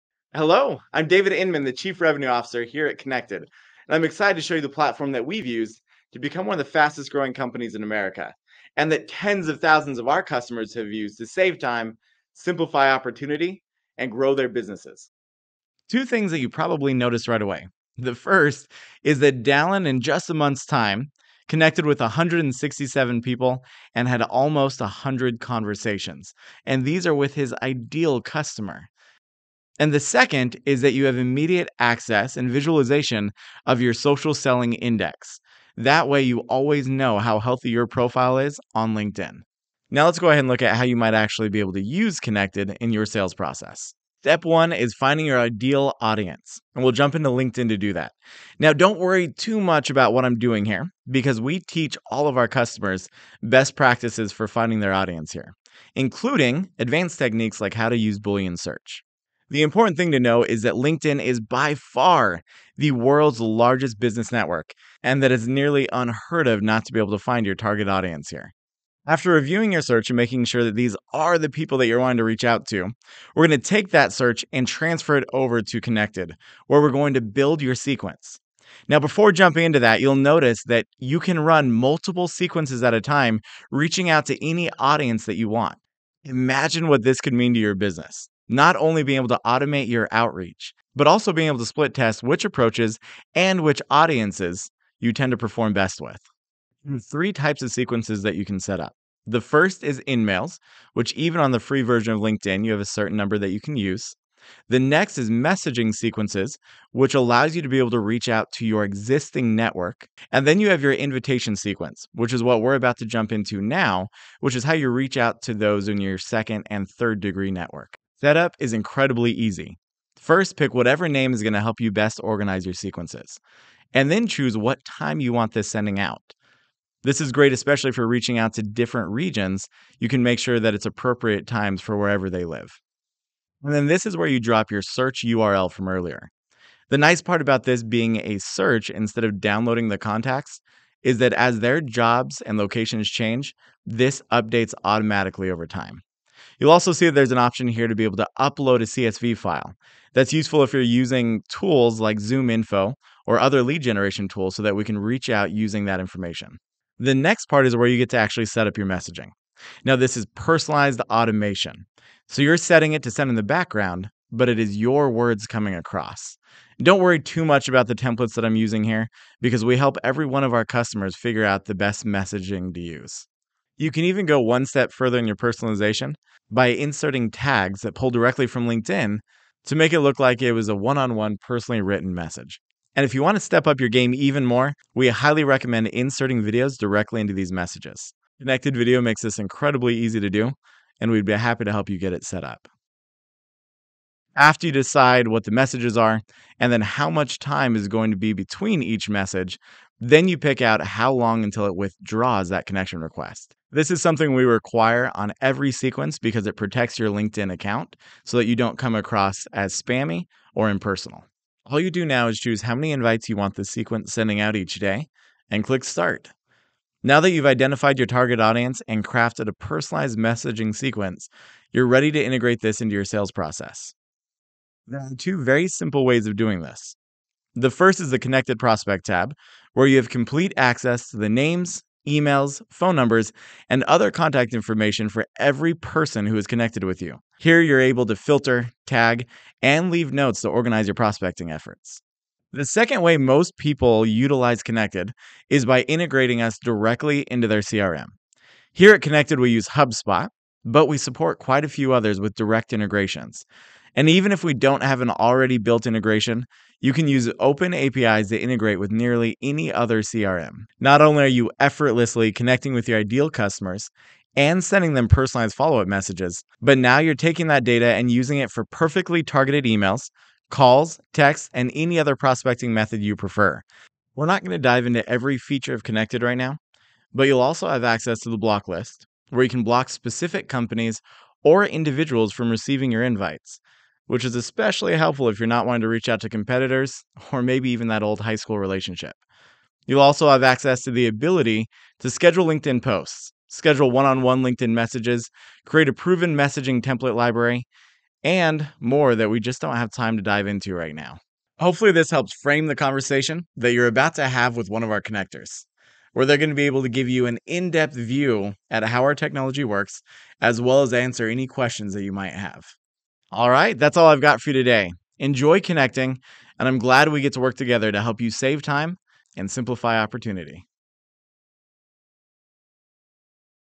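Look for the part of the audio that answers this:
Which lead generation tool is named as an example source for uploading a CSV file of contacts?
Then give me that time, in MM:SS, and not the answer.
02:32.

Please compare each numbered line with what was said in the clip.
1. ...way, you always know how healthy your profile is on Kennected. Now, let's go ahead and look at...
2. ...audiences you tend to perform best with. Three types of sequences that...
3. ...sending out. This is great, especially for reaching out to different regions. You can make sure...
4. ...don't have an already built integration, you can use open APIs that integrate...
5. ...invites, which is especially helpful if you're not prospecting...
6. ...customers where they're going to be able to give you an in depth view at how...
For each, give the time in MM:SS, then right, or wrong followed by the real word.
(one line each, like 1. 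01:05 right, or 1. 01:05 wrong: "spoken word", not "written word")
1. 00:36 wrong: "LinkedIn", not "Kennected"
2. 01:33 right
3. 02:05 right
4. 04:14 right
5. 04:43 wrong: "wanting", not "prospecting"
6. 05:05 wrong: "connectors", not "customers".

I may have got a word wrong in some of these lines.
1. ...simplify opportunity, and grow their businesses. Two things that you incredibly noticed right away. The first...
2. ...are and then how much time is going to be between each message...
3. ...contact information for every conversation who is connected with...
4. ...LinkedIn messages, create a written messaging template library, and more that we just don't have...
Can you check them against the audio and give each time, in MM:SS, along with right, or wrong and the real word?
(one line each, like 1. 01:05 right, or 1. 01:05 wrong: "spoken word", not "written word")
1. 00:12 wrong: "probably", not "incredibly"
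2. 03:15 right
3. 03:54 wrong: "person", not "conversation"
4. 04:54 wrong: "proven", not "written".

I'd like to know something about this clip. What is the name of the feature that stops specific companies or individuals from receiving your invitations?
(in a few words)
block list.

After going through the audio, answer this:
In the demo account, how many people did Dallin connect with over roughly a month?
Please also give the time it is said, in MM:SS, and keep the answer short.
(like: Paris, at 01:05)
167, at 00:21.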